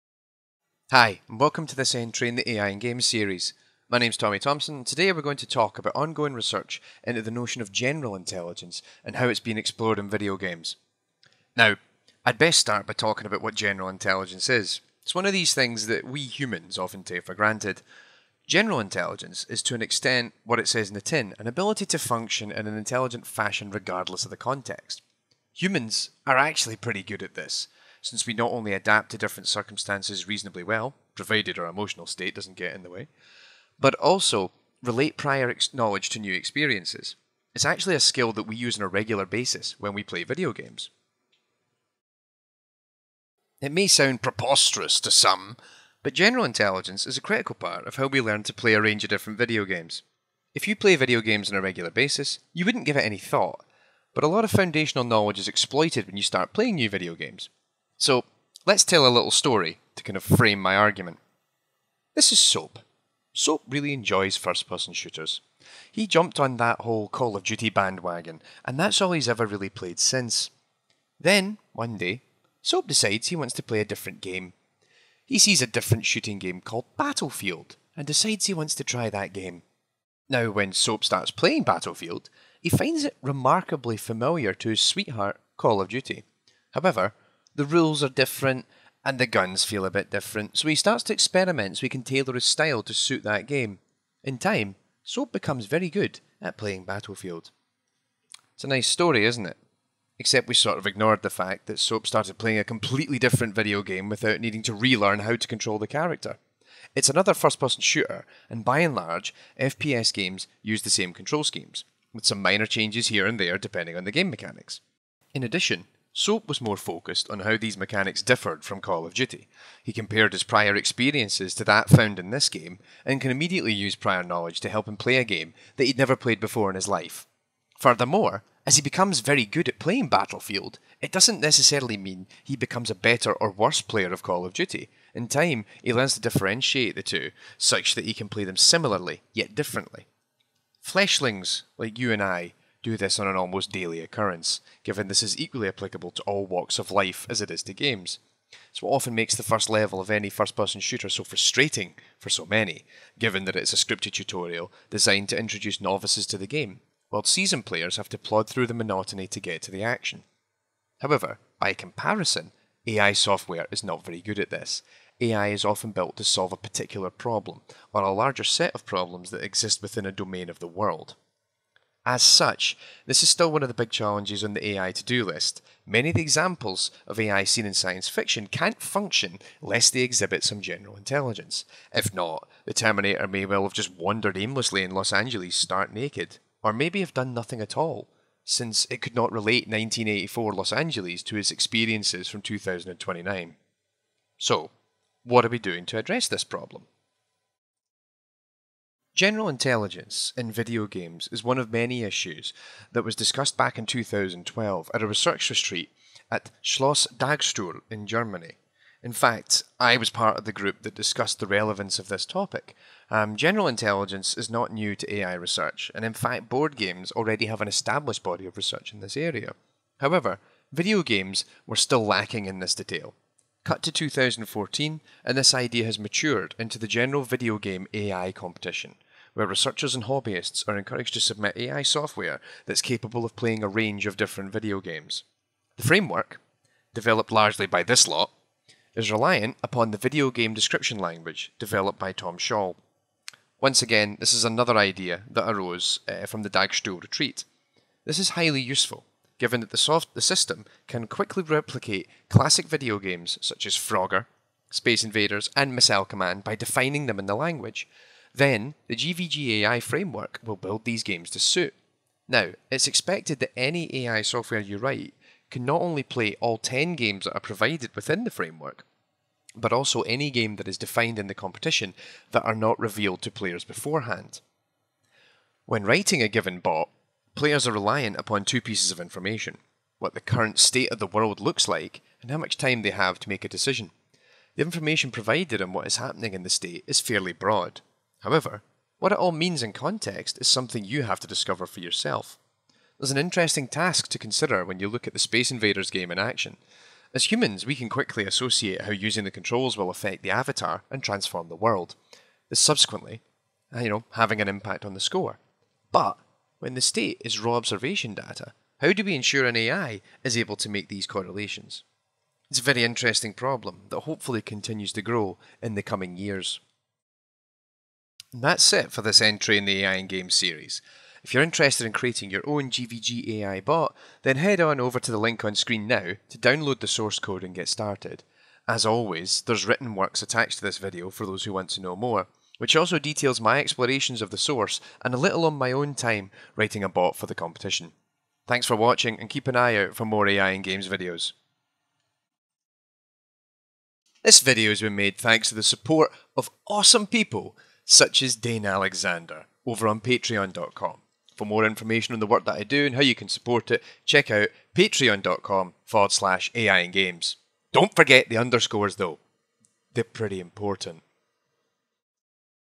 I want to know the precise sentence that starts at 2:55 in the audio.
Many of the examples of AI seen in science fiction can't function unless they exhibit some general intelligence.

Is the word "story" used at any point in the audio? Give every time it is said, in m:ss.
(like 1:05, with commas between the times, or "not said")
0:59, 1:38.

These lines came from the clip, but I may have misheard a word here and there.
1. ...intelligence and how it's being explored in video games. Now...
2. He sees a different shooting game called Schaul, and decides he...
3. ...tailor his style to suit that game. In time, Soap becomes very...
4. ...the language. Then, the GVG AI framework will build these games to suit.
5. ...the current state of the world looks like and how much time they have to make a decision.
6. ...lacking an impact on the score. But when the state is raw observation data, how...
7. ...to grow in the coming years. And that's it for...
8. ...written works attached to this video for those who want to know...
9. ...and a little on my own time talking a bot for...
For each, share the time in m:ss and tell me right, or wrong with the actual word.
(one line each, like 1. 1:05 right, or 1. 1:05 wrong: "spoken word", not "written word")
1. 0:08 right
2. 1:15 wrong: "Battlefield", not "Schaul"
3. 1:32 right
4. 4:17 right
5. 4:40 right
6. 5:04 wrong: "having", not "lacking"
7. 5:14 right
8. 5:29 right
9. 5:35 wrong: "writing", not "talking".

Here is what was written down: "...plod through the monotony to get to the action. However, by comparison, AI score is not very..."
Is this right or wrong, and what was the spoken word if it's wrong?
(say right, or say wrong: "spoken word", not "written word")
wrong: "software", not "score".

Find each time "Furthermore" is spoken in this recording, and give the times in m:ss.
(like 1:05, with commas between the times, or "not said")
2:07.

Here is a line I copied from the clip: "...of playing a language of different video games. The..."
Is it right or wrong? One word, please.
wrong.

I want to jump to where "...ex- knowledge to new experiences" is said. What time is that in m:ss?
0:35.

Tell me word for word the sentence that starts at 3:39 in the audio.
However, video games were still lacking in this detail.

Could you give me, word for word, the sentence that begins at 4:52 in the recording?
There's an interesting task to consider when you look at the Space Invaders game in action.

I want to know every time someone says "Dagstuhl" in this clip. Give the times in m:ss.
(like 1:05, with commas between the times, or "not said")
3:27, 4:06.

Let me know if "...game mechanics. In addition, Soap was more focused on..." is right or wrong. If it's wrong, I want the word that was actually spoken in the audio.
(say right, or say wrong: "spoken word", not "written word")
right.